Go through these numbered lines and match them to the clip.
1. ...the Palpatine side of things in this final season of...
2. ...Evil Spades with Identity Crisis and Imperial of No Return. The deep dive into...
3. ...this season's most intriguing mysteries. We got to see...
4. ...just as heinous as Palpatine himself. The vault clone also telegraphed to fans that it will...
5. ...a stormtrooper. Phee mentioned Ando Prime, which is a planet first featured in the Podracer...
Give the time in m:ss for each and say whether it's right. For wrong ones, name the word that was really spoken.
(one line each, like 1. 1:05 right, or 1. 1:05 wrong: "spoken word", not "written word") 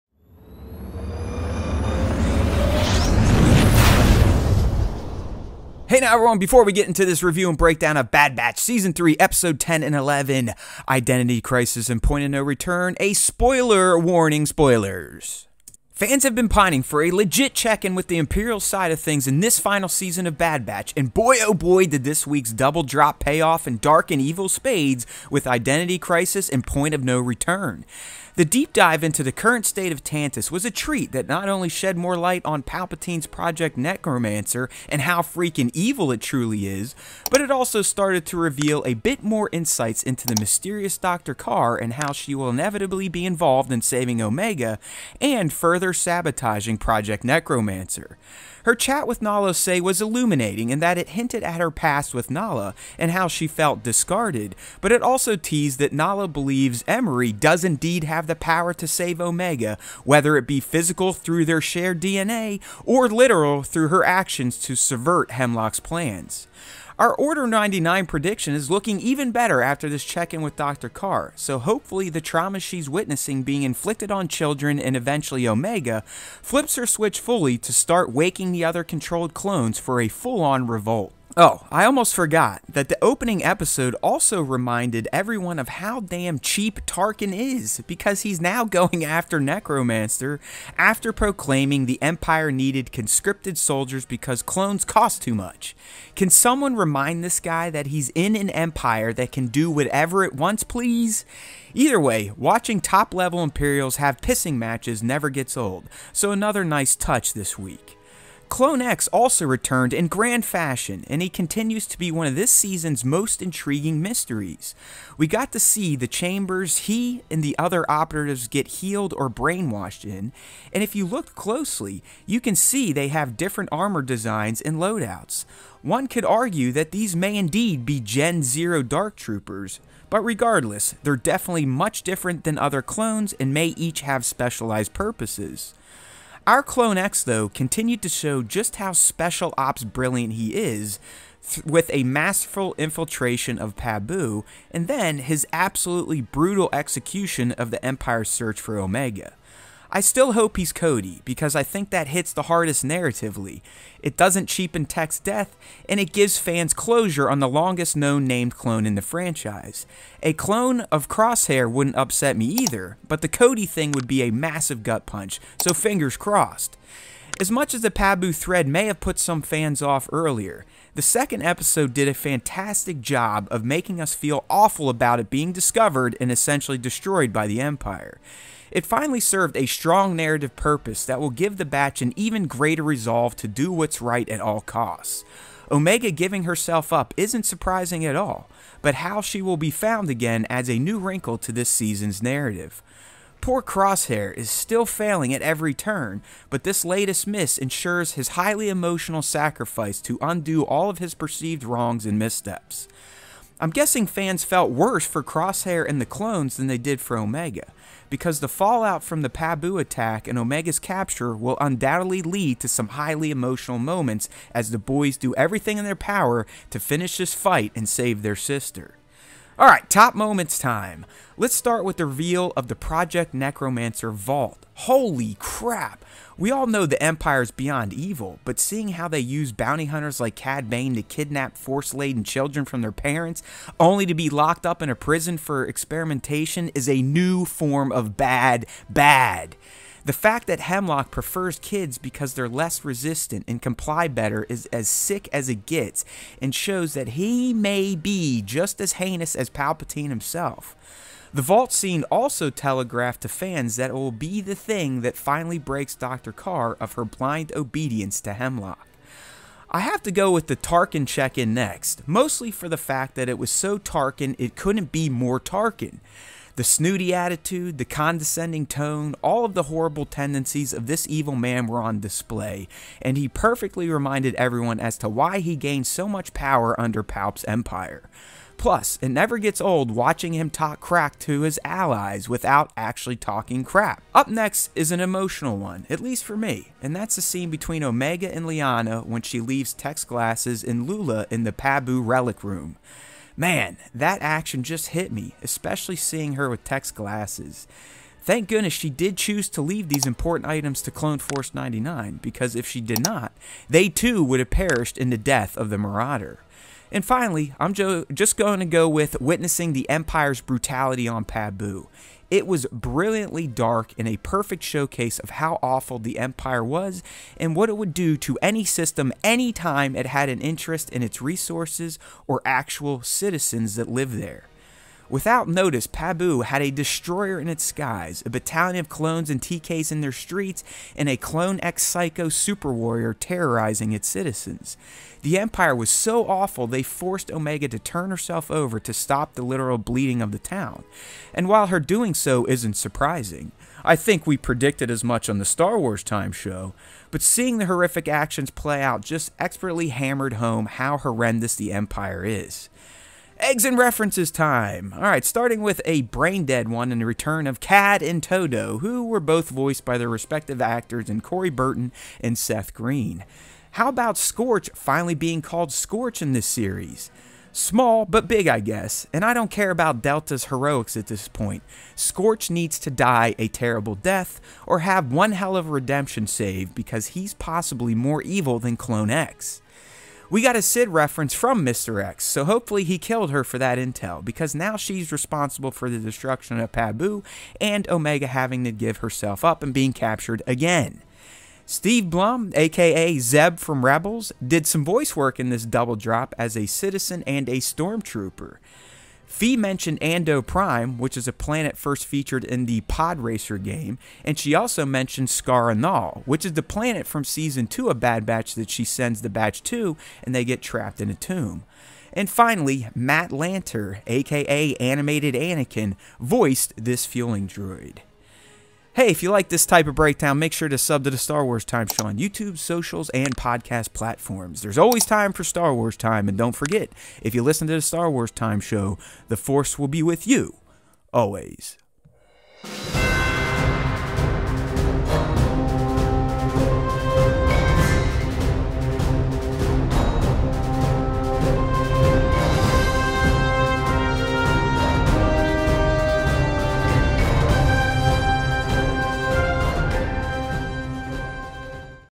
1. 0:18 wrong: "Imperial", not "Palpatine"
2. 0:24 wrong: "Point", not "Imperial"
3. 1:52 right
4. 4:08 wrong: "scene", not "clone"
5. 6:37 right.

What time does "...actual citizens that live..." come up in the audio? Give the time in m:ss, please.
5:22.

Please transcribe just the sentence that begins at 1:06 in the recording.
Our Order 99 prediction is looking even better after this check in with Dr.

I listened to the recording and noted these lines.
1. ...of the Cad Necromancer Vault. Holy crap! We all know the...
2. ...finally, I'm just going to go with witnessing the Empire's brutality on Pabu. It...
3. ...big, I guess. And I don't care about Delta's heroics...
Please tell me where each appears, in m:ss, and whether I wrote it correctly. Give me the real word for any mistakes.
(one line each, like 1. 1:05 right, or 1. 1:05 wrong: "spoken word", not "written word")
1. 3:42 wrong: "Project", not "Cad"
2. 5:07 right
3. 6:08 right.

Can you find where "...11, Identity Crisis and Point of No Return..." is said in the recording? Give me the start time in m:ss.
0:09.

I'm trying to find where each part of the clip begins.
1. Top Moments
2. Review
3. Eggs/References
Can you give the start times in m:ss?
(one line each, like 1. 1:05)
1. 3:41
2. 0:17
3. 5:53.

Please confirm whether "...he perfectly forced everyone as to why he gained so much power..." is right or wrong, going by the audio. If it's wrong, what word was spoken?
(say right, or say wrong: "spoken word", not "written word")
wrong: "reminded", not "forced".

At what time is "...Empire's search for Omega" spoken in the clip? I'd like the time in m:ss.
2:27.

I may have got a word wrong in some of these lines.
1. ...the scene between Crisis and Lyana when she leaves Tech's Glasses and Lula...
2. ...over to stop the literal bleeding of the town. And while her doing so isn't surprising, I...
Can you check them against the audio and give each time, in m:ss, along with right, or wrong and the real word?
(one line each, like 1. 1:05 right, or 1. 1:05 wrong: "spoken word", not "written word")
1. 4:47 wrong: "Omega", not "Crisis"
2. 5:38 right.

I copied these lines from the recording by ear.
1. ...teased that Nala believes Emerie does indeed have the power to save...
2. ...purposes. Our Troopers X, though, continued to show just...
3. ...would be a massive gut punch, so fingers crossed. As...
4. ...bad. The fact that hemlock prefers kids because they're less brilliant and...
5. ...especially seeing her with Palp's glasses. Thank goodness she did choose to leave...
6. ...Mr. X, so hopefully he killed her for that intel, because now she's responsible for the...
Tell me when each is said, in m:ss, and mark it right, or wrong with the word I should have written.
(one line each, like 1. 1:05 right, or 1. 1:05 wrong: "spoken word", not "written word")
1. 0:55 right
2. 2:14 wrong: "Clone", not "Troopers"
3. 2:43 right
4. 3:58 wrong: "resistant", not "brilliant"
5. 4:55 wrong: "Tech", not "Palp"
6. 6:21 right.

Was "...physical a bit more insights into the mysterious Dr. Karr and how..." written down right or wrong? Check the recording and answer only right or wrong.
wrong.